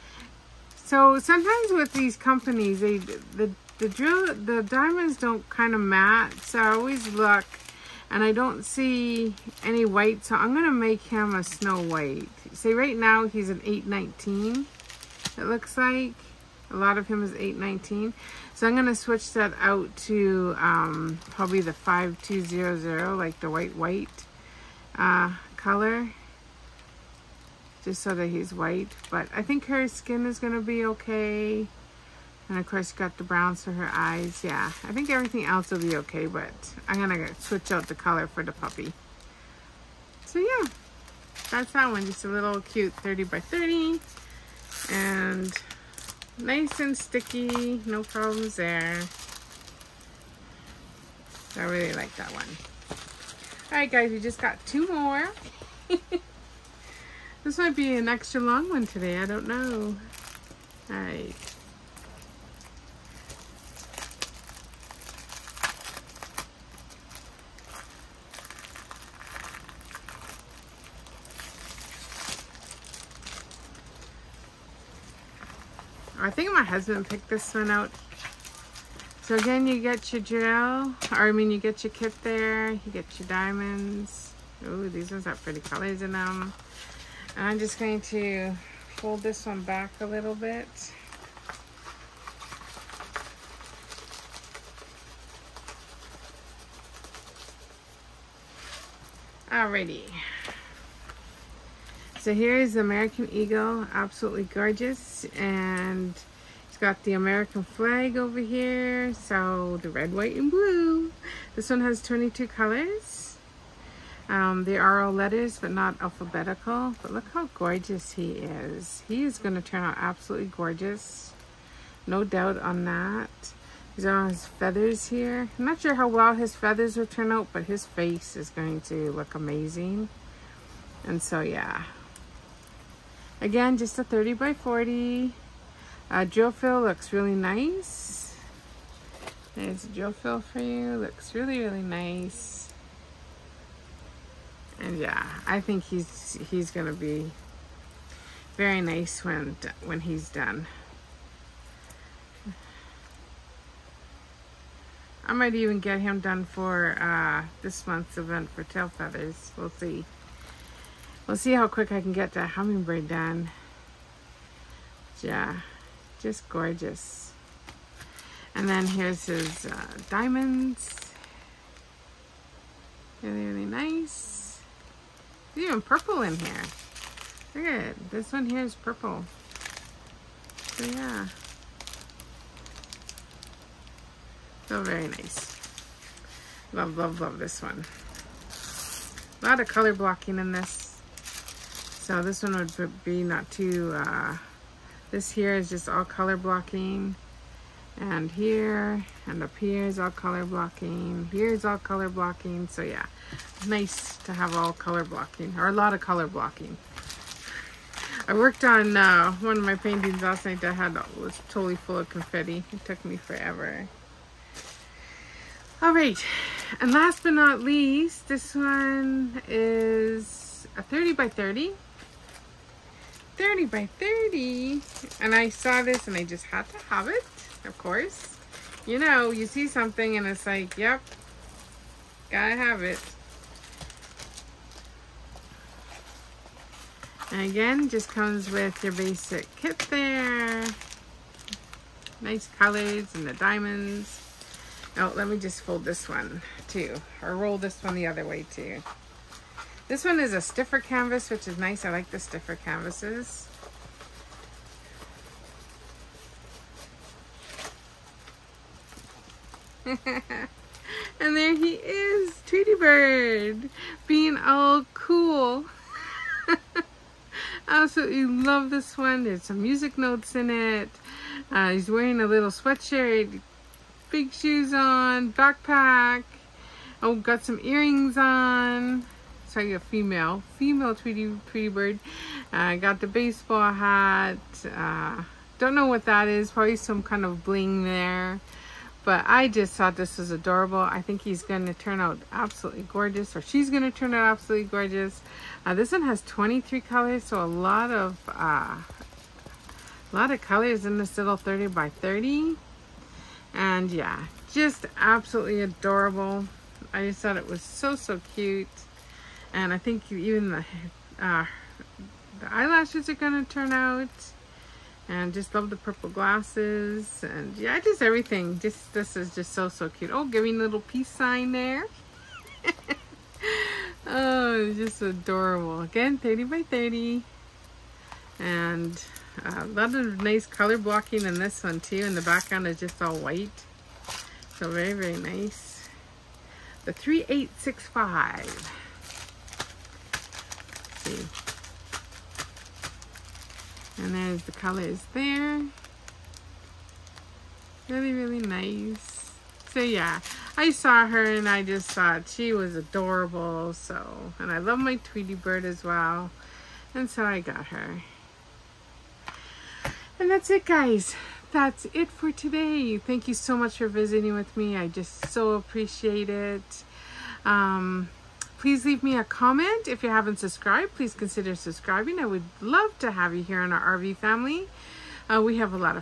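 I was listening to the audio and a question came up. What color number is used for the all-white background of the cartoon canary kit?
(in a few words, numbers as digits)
3865.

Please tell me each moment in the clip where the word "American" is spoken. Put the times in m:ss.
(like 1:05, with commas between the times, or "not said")
1:42, 1:47.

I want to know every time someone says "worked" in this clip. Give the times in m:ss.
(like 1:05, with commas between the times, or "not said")
3:28.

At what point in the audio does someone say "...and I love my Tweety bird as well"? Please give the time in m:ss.
5:54.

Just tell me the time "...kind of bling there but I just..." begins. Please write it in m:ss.
4:47.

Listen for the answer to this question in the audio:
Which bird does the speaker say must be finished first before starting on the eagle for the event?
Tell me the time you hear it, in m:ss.
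2:42.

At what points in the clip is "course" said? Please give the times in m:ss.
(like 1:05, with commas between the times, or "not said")
0:32, 3:47.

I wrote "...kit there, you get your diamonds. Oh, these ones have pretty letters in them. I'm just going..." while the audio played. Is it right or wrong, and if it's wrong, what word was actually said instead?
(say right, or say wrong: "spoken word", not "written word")
wrong: "colors", not "letters".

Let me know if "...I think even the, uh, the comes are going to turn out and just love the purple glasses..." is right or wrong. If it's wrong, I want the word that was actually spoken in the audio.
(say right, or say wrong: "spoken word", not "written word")
wrong: "eyelashes", not "comes".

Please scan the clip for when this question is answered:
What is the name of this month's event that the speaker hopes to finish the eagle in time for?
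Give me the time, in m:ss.
2:38.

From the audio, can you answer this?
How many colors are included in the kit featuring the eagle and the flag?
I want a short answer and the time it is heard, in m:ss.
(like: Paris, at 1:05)
22, at 1:52.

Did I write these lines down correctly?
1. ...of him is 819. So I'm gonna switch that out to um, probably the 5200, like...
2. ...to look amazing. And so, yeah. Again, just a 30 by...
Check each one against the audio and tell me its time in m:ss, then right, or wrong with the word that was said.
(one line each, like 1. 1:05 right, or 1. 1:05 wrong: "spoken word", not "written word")
1. 0:16 right
2. 2:08 right.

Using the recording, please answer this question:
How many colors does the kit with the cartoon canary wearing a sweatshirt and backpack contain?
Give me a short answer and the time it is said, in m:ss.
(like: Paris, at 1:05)
23, at 4:56.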